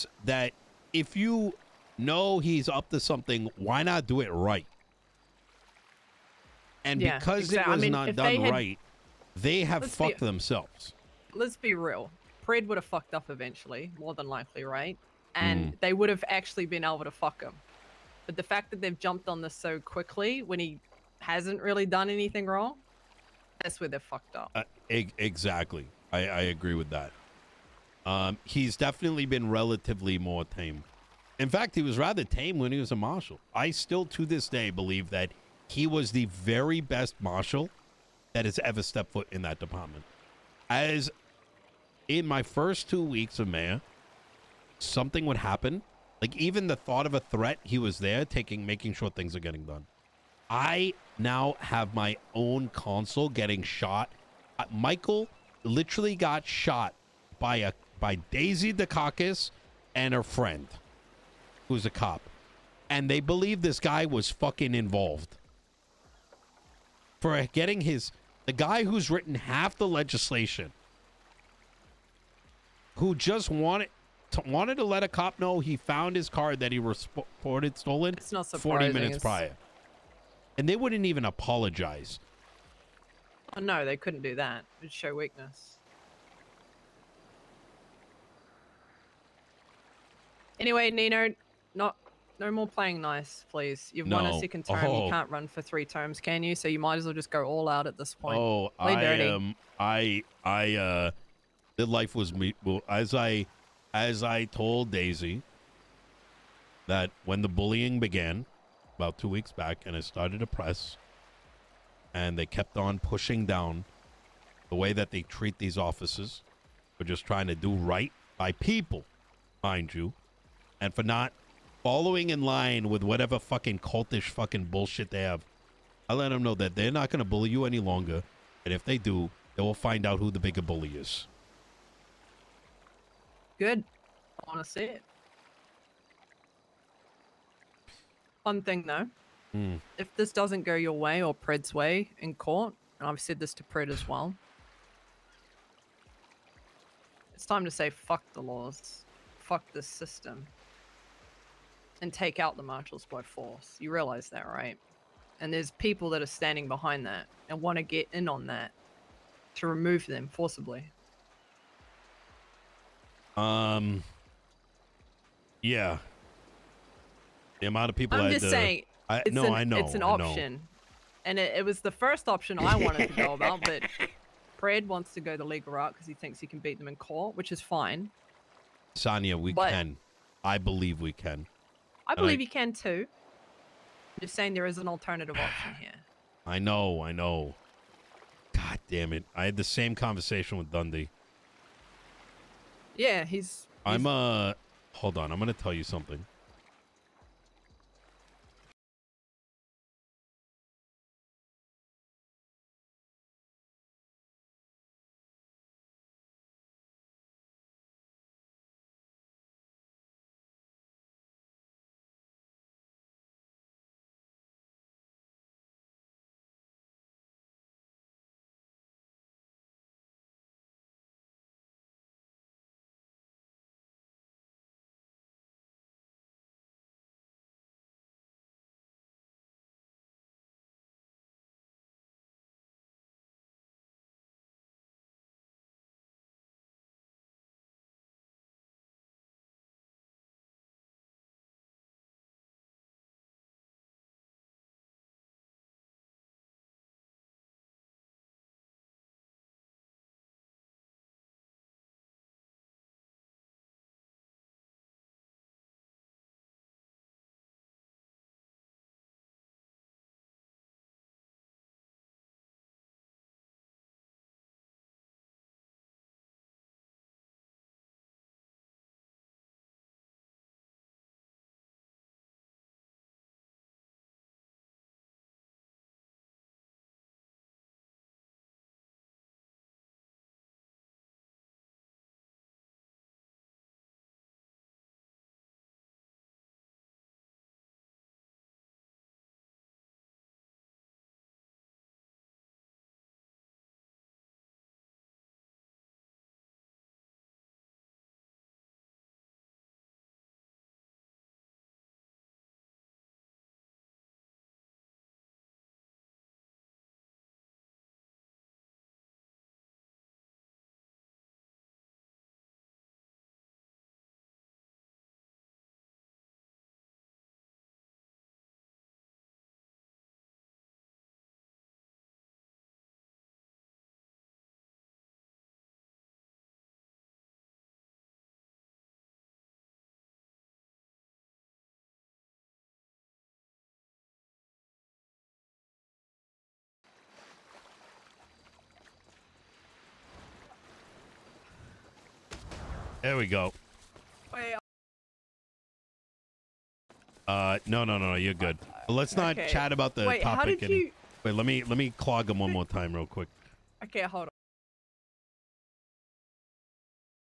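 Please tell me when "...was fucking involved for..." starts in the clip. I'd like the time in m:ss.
1:04.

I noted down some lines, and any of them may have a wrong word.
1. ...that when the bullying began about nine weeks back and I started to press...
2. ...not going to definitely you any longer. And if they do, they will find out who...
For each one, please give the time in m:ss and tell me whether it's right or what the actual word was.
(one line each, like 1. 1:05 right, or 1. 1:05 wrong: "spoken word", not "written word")
1. 1:46 wrong: "two", not "nine"
2. 2:06 wrong: "bully", not "definitely".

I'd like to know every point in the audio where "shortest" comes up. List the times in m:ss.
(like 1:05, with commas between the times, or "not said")
not said.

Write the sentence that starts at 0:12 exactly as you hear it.
Pred would have fucked up eventually, more than likely, right?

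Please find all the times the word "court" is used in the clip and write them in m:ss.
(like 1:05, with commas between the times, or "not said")
2:22, 2:56.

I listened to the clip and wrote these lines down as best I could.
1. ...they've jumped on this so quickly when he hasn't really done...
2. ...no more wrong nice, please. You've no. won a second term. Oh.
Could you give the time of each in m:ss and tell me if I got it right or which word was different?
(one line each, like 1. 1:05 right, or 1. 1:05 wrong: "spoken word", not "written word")
1. 0:18 right
2. 1:32 wrong: "playing", not "wrong".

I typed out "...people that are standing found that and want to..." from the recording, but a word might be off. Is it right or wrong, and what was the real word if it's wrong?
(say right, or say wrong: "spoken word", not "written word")
wrong: "behind", not "found".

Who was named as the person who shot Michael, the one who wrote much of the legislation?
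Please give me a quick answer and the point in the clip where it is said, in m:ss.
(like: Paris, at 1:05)
Daisy Dukakis, at 0:58.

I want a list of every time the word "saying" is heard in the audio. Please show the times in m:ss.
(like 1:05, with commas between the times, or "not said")
2:48, 3:04.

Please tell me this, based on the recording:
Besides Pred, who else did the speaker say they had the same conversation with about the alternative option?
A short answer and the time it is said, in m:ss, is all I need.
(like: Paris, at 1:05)
Dundee, at 3:10.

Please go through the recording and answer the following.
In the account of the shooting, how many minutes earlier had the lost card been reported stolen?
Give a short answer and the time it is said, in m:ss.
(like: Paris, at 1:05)
40, at 1:18.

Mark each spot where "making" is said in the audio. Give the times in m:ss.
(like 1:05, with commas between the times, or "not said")
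0:48.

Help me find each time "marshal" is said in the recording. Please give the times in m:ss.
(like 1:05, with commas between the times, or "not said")
0:32, 0:37, 2:32.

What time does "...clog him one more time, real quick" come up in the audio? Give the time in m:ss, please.
5:51.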